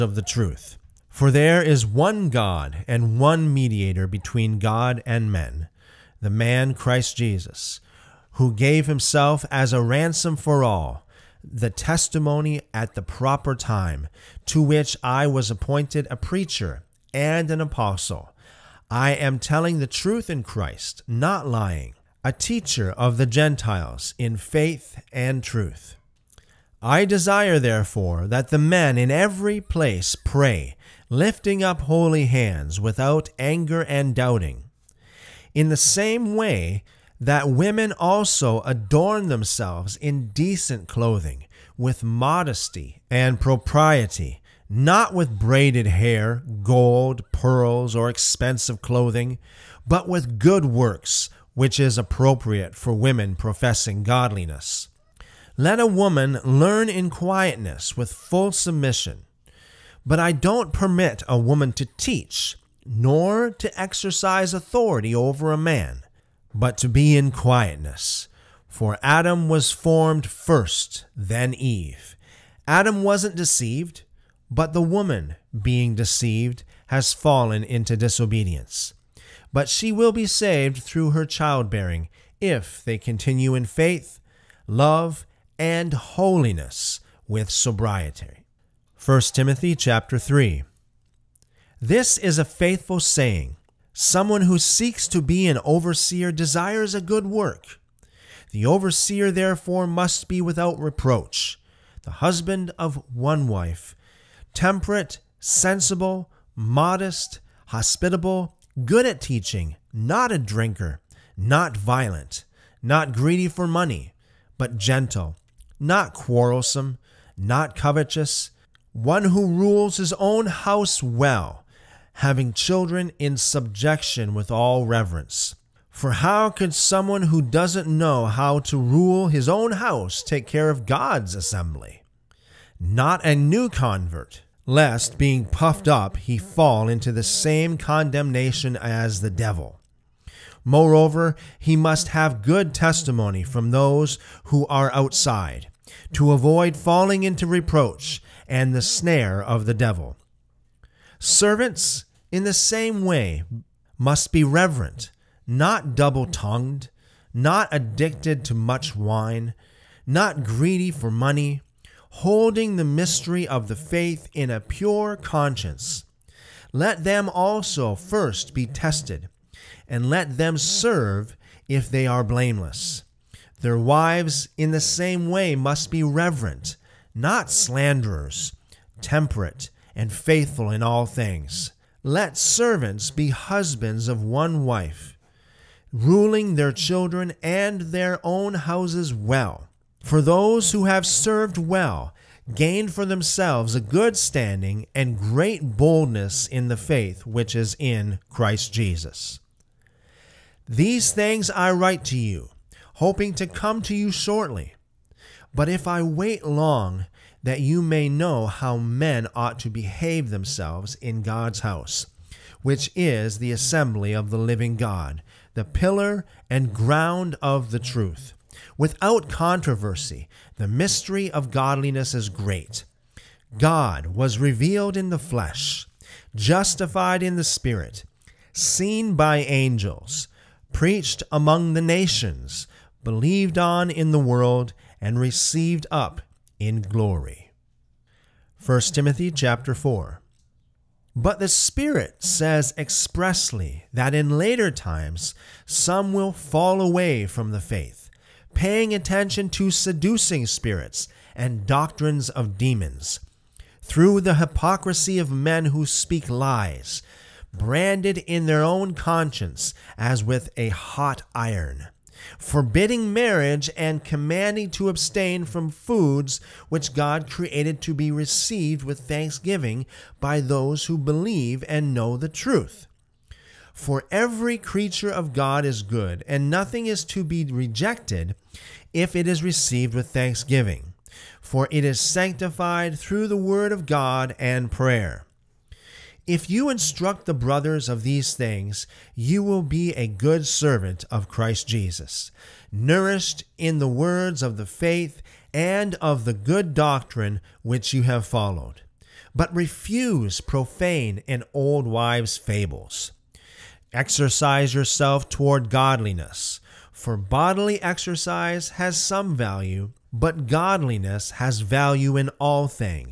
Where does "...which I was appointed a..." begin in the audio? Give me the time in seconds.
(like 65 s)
14 s.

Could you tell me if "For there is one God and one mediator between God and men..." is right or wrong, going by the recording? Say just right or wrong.
right.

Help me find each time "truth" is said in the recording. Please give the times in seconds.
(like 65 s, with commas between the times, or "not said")
0 s, 19 s, 25 s, 217 s, 272 s.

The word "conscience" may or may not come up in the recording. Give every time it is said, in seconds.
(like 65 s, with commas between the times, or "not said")
165 s, 258 s.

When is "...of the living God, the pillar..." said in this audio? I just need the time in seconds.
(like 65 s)
214 s.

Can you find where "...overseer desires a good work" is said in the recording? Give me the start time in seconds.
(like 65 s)
95 s.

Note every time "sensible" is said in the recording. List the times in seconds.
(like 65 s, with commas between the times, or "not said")
105 s.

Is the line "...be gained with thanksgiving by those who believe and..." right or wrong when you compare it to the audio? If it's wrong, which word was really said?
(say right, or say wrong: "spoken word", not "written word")
wrong: "received", not "gained".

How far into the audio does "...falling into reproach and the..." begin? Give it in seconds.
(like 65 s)
146 s.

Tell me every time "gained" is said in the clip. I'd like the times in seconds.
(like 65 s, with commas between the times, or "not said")
192 s.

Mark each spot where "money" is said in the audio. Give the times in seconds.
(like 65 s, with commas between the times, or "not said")
113 s, 161 s.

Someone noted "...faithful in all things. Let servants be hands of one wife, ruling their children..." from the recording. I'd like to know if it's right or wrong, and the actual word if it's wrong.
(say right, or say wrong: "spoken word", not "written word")
wrong: "husbands", not "hands".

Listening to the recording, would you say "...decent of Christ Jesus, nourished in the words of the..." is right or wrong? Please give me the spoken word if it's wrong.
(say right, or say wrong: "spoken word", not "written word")
wrong: "servant", not "decent".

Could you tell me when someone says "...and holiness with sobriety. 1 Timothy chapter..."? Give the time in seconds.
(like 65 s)
85 s.